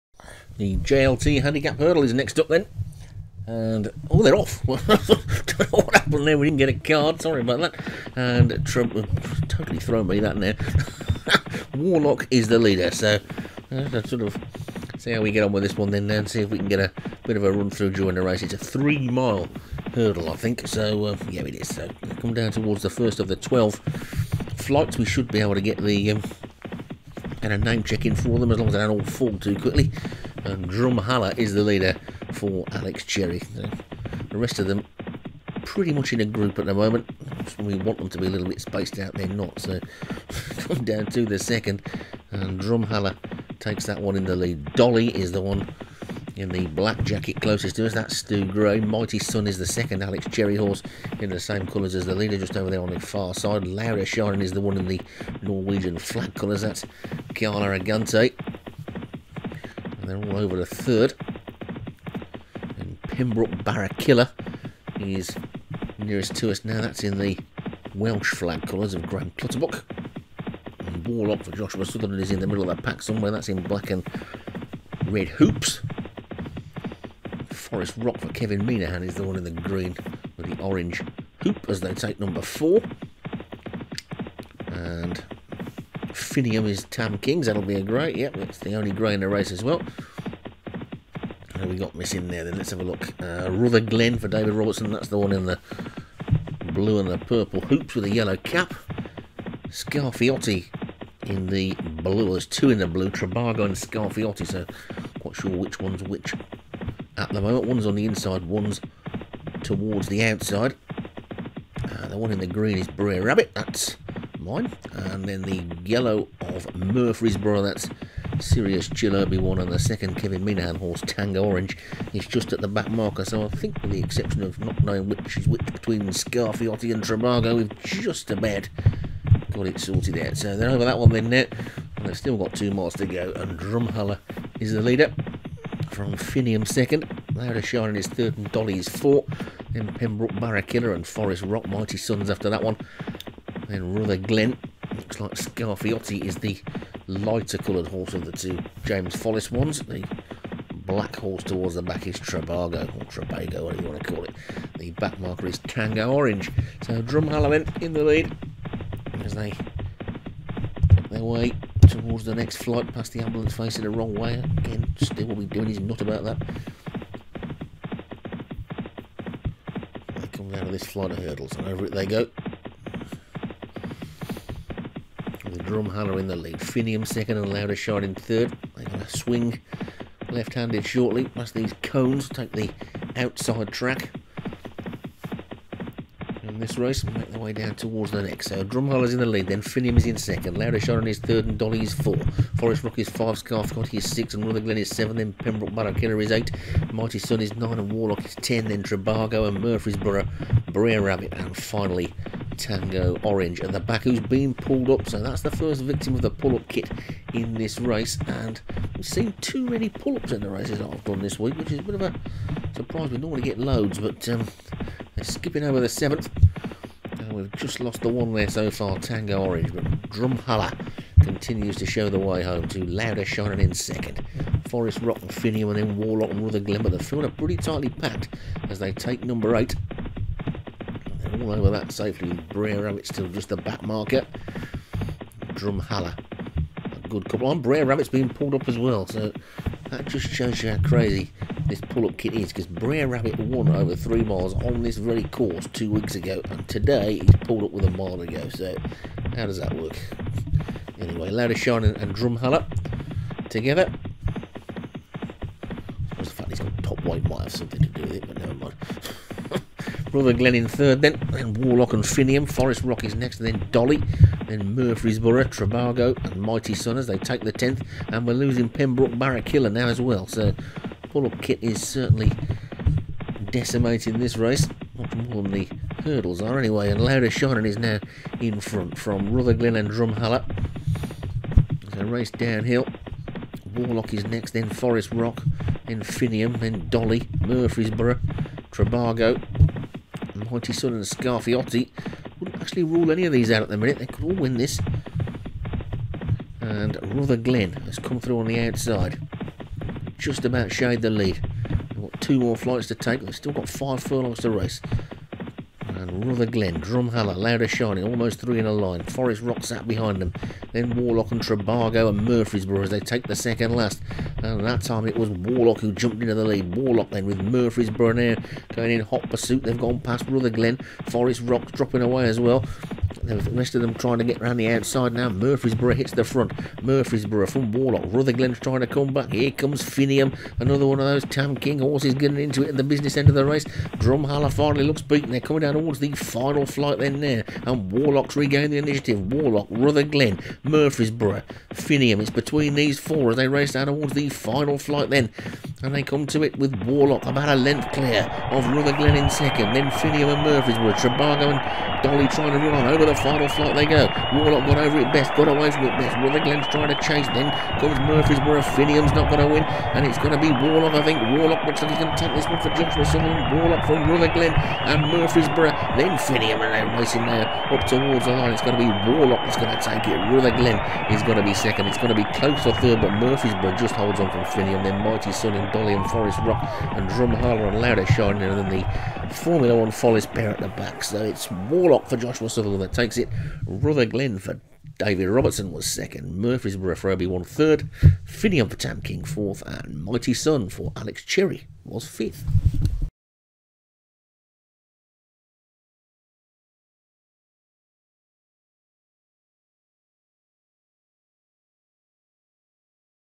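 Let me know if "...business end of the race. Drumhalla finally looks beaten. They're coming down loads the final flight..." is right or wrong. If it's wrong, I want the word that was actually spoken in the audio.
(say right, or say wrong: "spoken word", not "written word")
wrong: "towards", not "loads".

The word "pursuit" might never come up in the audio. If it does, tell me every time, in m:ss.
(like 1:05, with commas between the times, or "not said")
5:19.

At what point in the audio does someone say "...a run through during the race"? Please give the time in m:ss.
0:17.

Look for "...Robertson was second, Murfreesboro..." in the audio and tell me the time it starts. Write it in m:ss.
6:25.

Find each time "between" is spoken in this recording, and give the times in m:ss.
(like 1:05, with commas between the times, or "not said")
2:05, 5:42.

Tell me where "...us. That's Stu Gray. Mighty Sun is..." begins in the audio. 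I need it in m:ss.
0:47.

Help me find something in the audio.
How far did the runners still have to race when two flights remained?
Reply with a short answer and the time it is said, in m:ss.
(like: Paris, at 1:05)
5 furlongs, at 5:03.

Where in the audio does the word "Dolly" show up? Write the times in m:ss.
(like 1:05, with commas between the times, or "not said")
0:44, 2:18, 3:11, 4:23, 4:46, 5:52, 6:15.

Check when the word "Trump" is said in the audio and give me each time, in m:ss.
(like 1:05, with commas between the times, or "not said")
0:08.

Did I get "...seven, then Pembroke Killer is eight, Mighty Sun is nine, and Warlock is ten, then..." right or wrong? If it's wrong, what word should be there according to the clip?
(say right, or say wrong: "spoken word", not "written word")
right.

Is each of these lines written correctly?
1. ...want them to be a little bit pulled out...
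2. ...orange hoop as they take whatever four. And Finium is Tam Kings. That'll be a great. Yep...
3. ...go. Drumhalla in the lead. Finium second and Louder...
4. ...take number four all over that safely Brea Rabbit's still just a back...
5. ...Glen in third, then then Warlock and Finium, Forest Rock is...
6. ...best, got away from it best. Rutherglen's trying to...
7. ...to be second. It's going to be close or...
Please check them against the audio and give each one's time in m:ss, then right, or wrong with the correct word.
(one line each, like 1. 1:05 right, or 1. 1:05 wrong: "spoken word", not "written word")
1. 0:37 wrong: "spaced", not "pulled"
2. 1:20 wrong: "number", not "whatever"
3. 2:52 right
4. 3:48 wrong: "eight", not "four"
5. 4:20 right
6. 5:55 right
7. 6:11 right.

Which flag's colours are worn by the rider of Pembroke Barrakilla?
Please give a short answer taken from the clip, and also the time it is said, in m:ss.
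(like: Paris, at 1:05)
Welsh flag, at 1:07.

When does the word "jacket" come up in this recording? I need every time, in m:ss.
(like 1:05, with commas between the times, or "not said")
0:47.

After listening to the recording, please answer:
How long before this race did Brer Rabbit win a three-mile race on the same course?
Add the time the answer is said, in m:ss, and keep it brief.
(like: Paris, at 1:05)
2 weeks, at 4:05.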